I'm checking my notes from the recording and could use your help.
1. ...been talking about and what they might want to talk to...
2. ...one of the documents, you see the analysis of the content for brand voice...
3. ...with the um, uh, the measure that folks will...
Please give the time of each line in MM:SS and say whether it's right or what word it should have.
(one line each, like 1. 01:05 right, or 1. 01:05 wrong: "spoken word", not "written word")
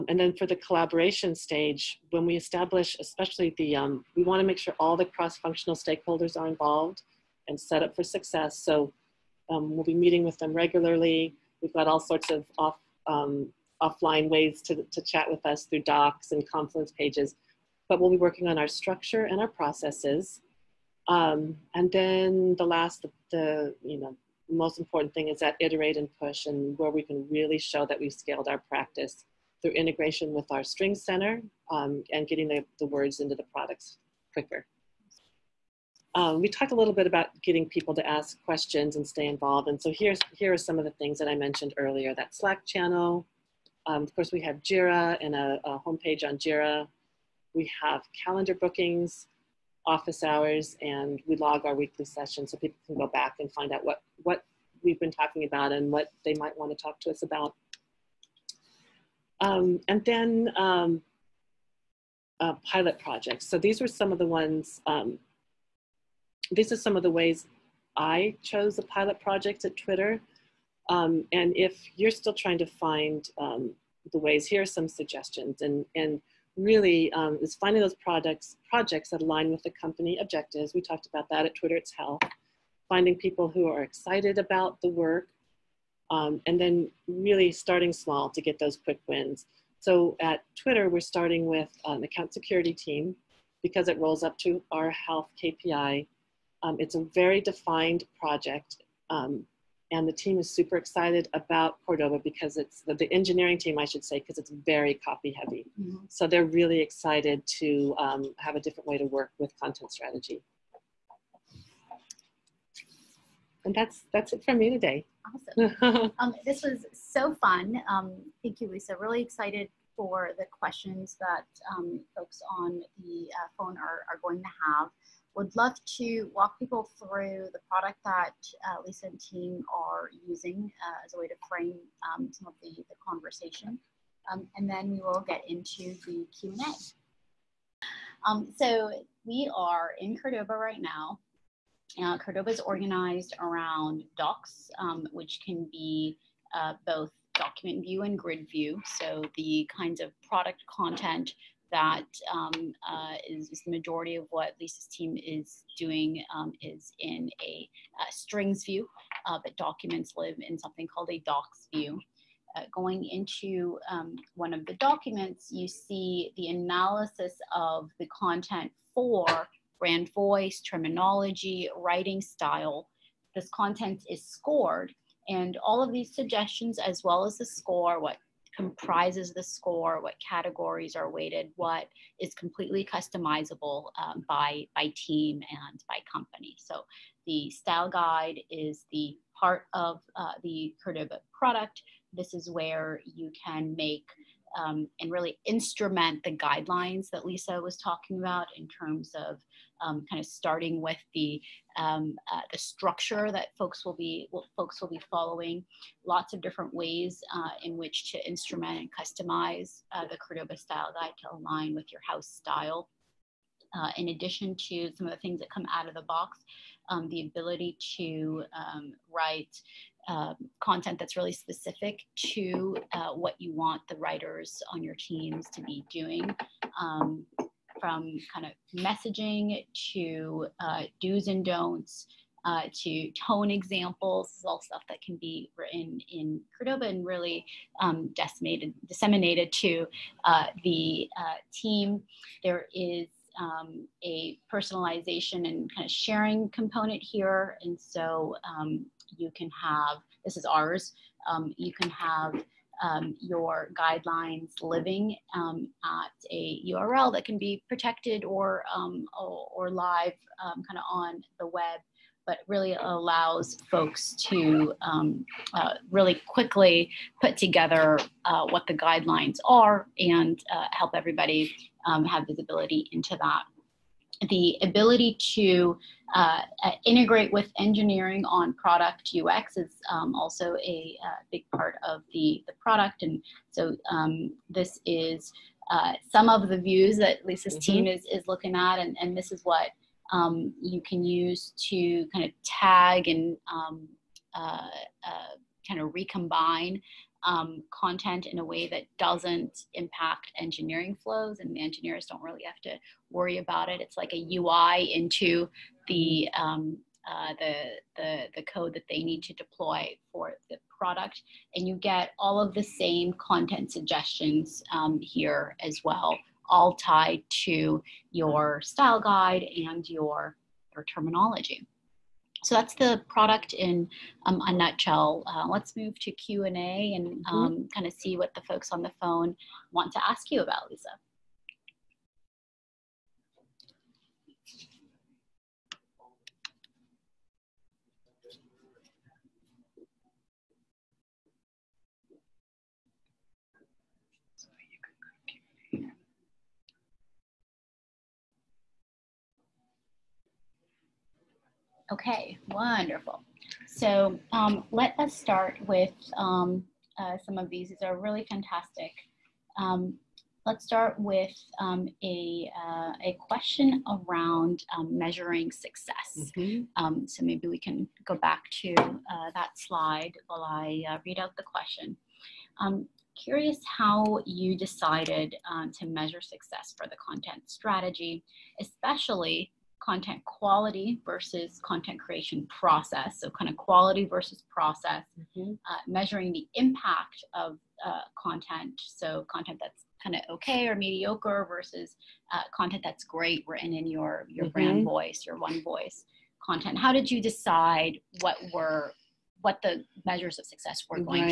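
1. 00:54 right
2. 02:44 right
3. 03:20 wrong: "structure", not "measure".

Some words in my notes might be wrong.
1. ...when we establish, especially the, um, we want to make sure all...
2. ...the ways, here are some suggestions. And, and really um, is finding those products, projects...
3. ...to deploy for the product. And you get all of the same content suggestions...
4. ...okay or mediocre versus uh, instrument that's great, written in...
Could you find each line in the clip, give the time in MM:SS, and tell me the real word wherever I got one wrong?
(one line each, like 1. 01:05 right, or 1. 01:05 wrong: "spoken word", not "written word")
1. 00:02 right
2. 01:14 right
3. 05:09 right
4. 06:30 wrong: "content", not "instrument".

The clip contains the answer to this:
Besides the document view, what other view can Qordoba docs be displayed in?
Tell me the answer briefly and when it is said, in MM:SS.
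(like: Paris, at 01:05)
Grid view, at 02:28.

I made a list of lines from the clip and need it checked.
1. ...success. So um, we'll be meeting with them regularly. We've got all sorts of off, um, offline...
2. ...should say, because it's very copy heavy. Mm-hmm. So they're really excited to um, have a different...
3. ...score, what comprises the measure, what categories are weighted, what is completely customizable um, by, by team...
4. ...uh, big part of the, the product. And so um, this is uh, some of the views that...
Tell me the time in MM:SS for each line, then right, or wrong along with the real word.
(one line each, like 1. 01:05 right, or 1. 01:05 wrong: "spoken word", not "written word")
1. 00:08 right
2. 01:43 right
3. 02:57 wrong: "score", not "measure"
4. 04:41 right.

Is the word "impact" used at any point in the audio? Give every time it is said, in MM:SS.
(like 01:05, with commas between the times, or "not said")
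04:59, 06:26.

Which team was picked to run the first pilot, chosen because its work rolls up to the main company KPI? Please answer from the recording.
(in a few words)
Account security team.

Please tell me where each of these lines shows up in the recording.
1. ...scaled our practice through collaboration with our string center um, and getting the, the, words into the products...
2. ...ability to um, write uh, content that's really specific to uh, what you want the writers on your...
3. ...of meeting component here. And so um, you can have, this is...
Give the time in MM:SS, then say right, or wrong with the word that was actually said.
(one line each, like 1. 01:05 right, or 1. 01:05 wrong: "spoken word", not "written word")
1. 00:28 wrong: "integration", not "collaboration"
2. 03:37 right
3. 04:05 wrong: "sharing", not "meeting".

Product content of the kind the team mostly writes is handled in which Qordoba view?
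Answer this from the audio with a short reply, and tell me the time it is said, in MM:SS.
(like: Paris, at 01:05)
Strings view, at 02:38.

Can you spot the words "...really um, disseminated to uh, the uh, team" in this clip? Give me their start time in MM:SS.
03:57.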